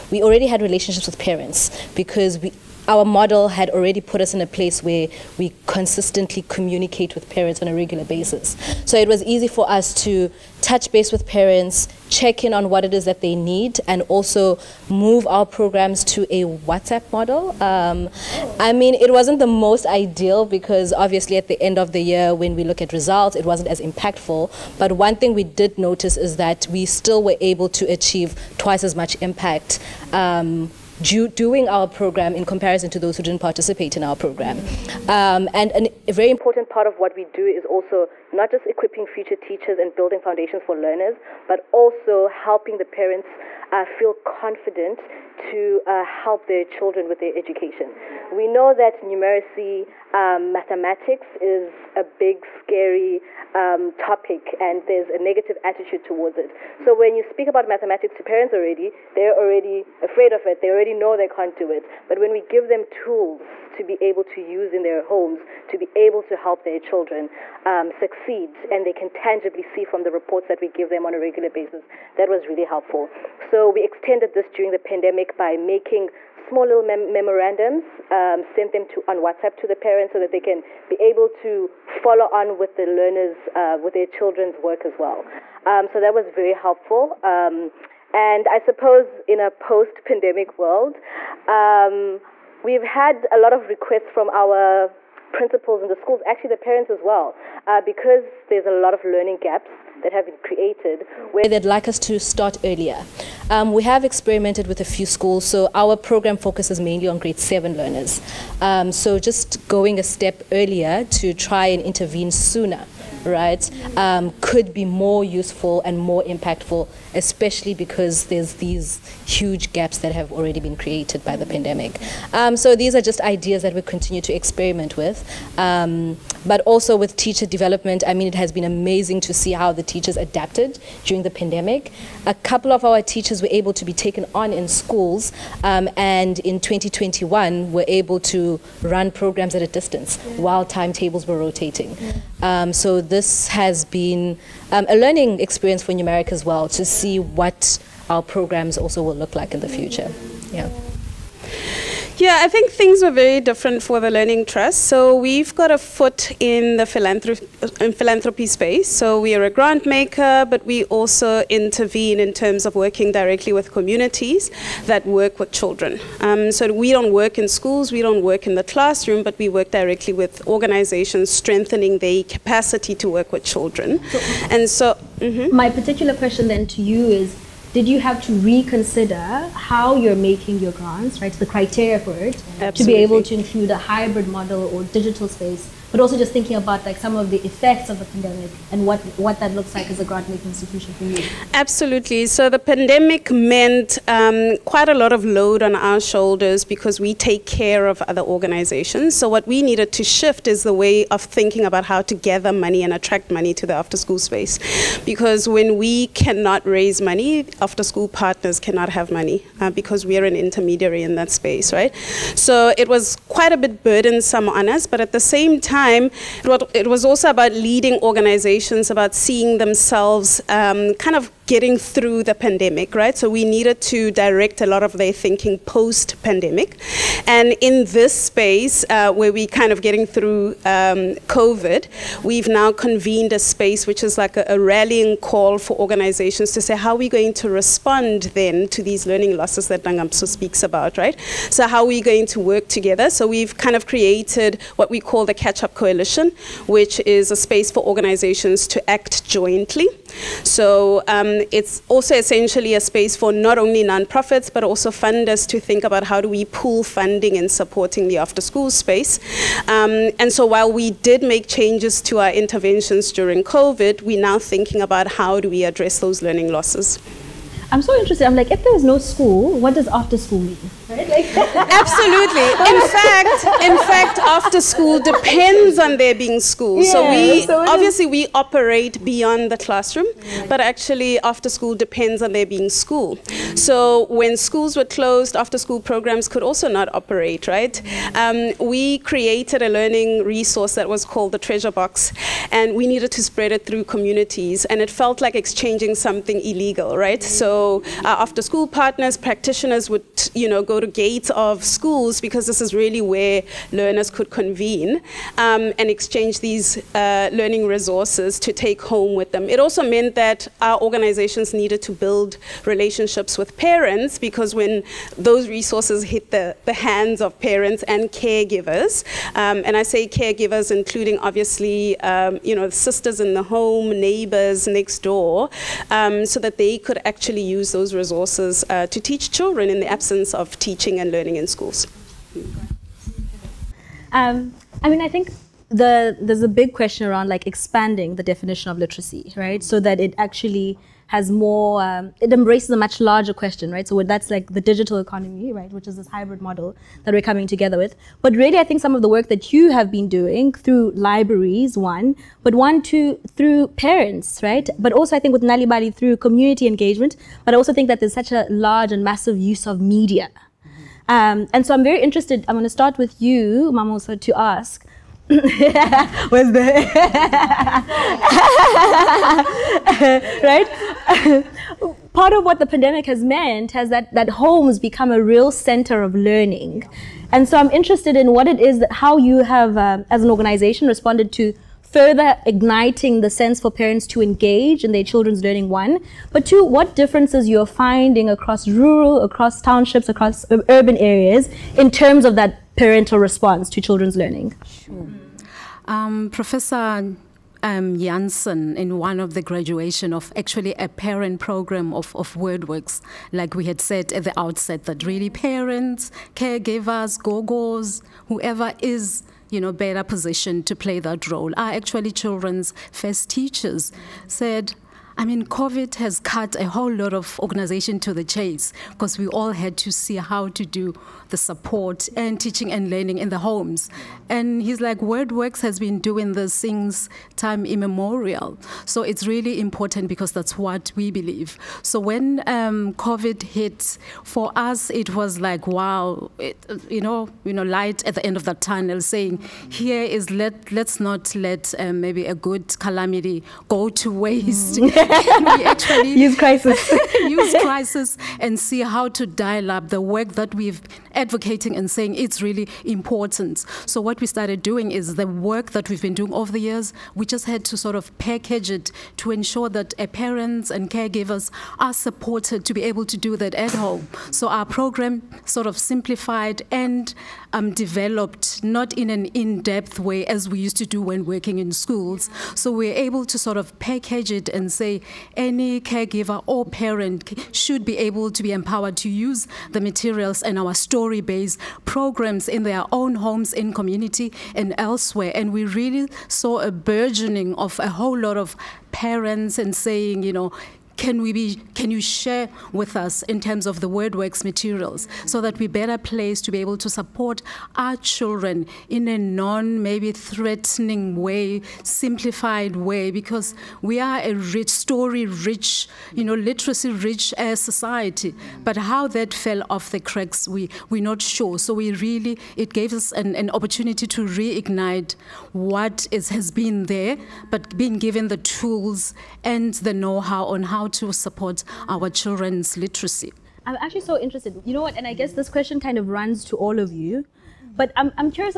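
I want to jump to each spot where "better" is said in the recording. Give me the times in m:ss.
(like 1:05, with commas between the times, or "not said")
6:49, 8:15.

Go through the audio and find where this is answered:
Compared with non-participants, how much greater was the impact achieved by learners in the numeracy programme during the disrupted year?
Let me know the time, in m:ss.
0:28.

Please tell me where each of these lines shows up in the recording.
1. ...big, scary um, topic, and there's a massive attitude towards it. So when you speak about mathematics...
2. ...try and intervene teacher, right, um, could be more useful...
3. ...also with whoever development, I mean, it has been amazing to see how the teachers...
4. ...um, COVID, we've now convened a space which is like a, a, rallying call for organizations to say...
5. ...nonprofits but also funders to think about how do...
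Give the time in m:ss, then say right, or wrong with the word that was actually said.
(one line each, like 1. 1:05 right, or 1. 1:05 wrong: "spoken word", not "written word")
1. 0:52 wrong: "negative", not "massive"
2. 1:51 wrong: "sooner", not "teacher"
3. 2:06 wrong: "teacher", not "whoever"
4. 3:50 right
5. 4:13 right.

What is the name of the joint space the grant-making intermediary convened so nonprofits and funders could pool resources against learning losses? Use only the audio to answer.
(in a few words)
Catch Up Coalition.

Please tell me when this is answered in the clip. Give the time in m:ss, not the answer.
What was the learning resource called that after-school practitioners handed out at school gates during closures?
4:51.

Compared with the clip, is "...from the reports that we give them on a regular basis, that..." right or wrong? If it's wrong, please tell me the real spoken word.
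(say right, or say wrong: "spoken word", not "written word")
right.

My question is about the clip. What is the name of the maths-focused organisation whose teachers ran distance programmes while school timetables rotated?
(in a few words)
Numeric.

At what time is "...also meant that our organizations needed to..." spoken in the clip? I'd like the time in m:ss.
5:09.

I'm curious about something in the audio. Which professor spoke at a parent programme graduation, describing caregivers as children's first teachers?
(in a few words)
Jansen.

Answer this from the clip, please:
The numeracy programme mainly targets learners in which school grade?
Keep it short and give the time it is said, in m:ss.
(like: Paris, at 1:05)
Grade 7, at 1:47.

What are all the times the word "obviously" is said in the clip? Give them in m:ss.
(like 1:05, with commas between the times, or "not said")
0:20, 4:37, 5:21.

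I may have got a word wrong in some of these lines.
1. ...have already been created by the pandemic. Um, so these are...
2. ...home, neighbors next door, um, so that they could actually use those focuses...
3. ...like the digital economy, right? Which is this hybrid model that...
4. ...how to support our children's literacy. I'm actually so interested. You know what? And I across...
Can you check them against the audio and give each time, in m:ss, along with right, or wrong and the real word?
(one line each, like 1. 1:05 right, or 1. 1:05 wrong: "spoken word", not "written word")
1. 2:00 right
2. 5:23 wrong: "resources", not "focuses"
3. 5:44 right
4. 8:40 wrong: "guess", not "across".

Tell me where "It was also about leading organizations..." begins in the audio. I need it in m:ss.
3:36.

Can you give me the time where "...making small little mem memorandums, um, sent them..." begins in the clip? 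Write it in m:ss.
1:15.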